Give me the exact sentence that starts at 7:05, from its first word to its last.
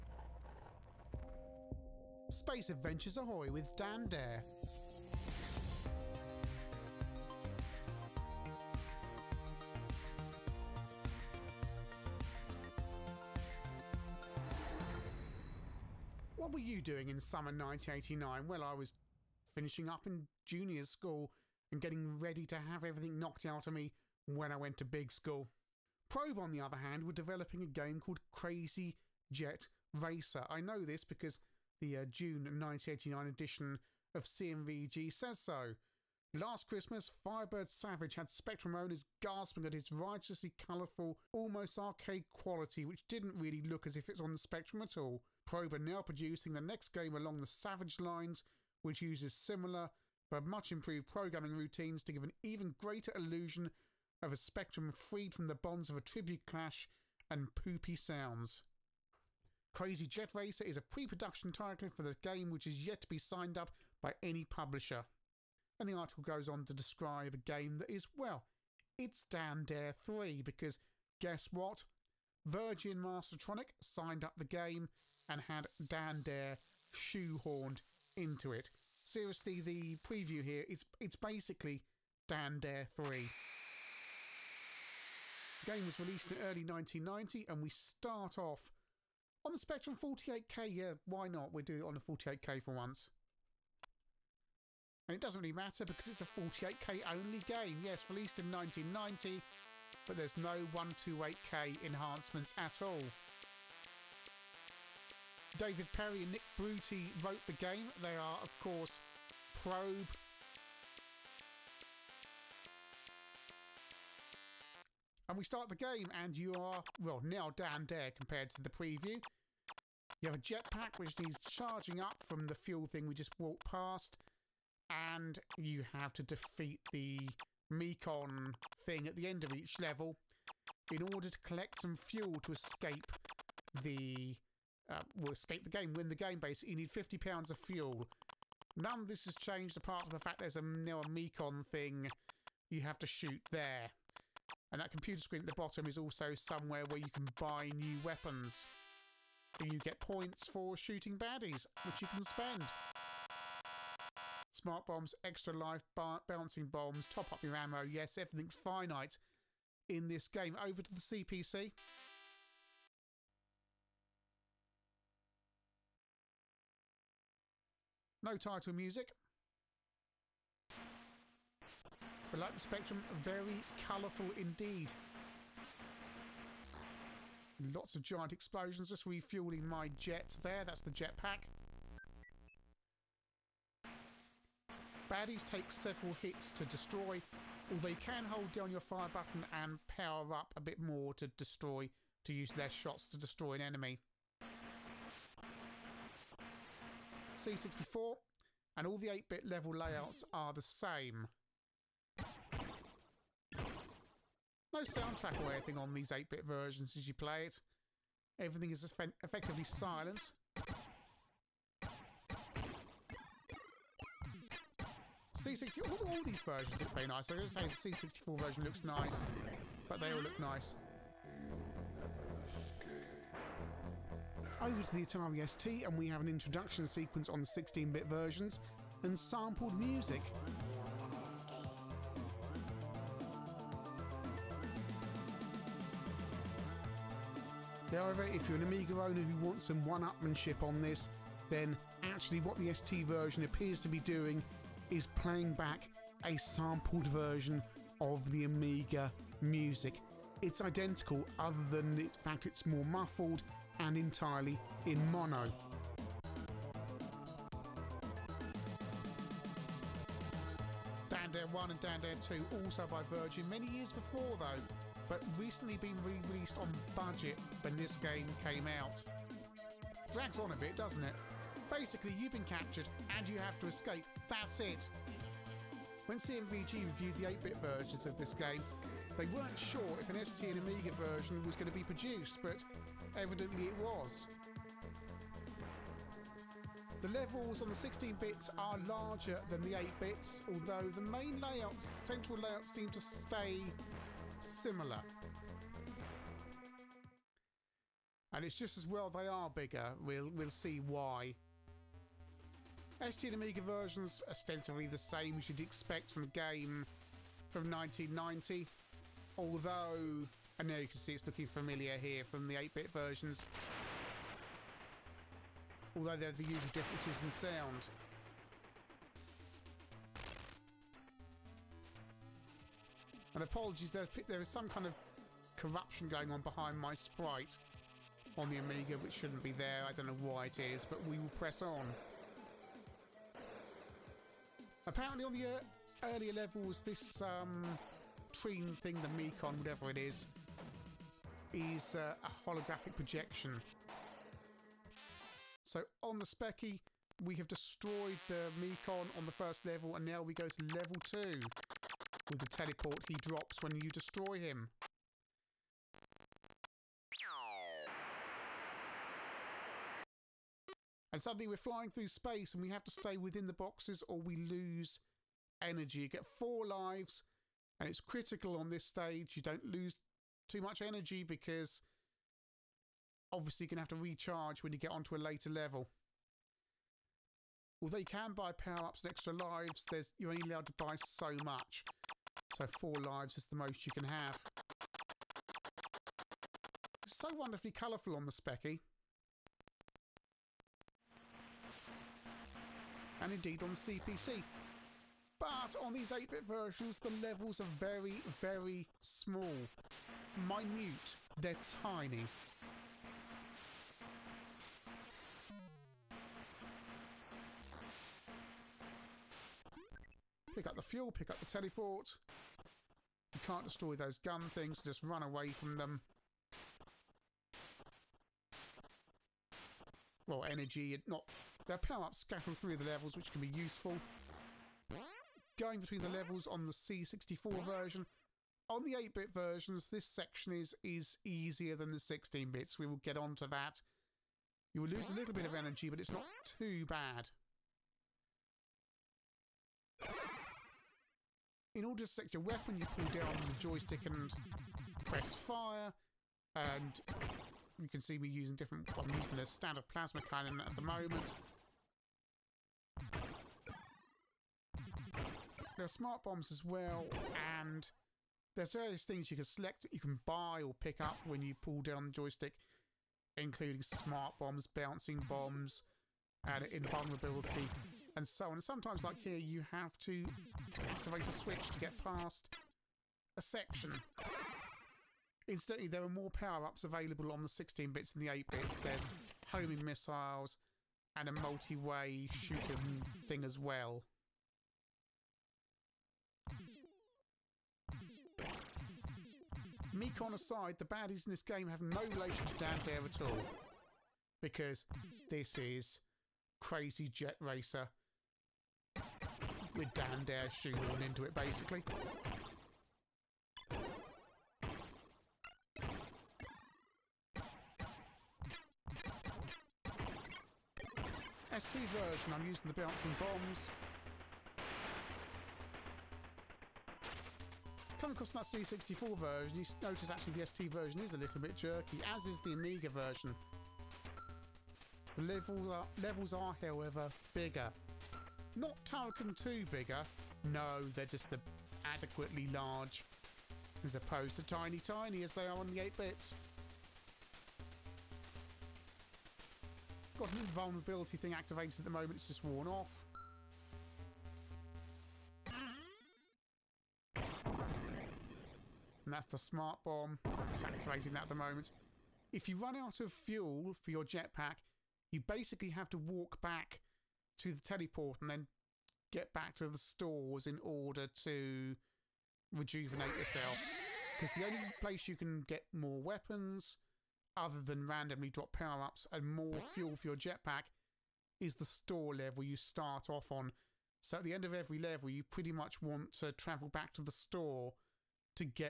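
Going between the levels on the C64 version.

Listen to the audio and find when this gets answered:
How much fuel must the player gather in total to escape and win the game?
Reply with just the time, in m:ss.
2:16.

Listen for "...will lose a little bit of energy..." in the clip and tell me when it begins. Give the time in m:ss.
7:14.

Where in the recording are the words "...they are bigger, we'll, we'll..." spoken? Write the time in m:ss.
4:59.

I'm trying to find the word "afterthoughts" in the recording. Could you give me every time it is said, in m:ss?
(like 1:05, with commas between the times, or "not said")
not said.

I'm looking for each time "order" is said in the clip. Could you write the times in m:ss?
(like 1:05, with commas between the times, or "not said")
2:11, 7:21, 9:20.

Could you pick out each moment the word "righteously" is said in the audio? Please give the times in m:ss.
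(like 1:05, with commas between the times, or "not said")
0:39.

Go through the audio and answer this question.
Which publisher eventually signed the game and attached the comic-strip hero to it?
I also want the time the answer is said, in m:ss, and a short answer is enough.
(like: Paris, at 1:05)
Virgin Mastertronic, at 1:12.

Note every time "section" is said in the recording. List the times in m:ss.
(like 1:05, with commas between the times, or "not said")
7:10, 7:53.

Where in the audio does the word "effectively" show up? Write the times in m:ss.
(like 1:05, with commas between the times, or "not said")
3:28.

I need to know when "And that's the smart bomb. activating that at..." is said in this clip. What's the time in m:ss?
9:09.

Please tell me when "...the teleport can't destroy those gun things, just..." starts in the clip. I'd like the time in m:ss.
6:51.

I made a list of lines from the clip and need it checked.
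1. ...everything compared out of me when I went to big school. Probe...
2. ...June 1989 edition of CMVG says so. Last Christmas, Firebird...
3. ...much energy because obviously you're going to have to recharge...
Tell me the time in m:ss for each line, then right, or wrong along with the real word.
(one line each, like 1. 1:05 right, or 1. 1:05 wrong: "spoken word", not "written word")
1. 0:22 wrong: "knocked", not "compared"
2. 0:32 right
3. 6:10 right.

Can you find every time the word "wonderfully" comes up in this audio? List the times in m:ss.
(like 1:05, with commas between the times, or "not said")
6:27.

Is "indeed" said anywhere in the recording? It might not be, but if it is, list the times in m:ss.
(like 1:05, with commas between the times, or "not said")
2:54, 6:33.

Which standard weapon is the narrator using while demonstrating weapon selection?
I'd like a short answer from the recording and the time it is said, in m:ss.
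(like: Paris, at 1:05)
plasma cannon, at 7:29.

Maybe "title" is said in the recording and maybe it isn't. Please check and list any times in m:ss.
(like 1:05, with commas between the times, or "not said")
1:01, 2:48.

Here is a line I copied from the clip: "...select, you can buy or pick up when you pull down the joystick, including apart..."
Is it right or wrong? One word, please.
wrong.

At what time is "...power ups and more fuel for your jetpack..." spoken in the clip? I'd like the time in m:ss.
9:28.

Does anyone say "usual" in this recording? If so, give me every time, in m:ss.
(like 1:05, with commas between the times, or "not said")
5:16.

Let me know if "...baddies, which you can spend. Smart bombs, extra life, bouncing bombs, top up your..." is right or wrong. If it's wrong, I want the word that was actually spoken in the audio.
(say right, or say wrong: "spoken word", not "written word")
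right.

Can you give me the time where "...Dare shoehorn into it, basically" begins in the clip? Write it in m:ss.
8:20.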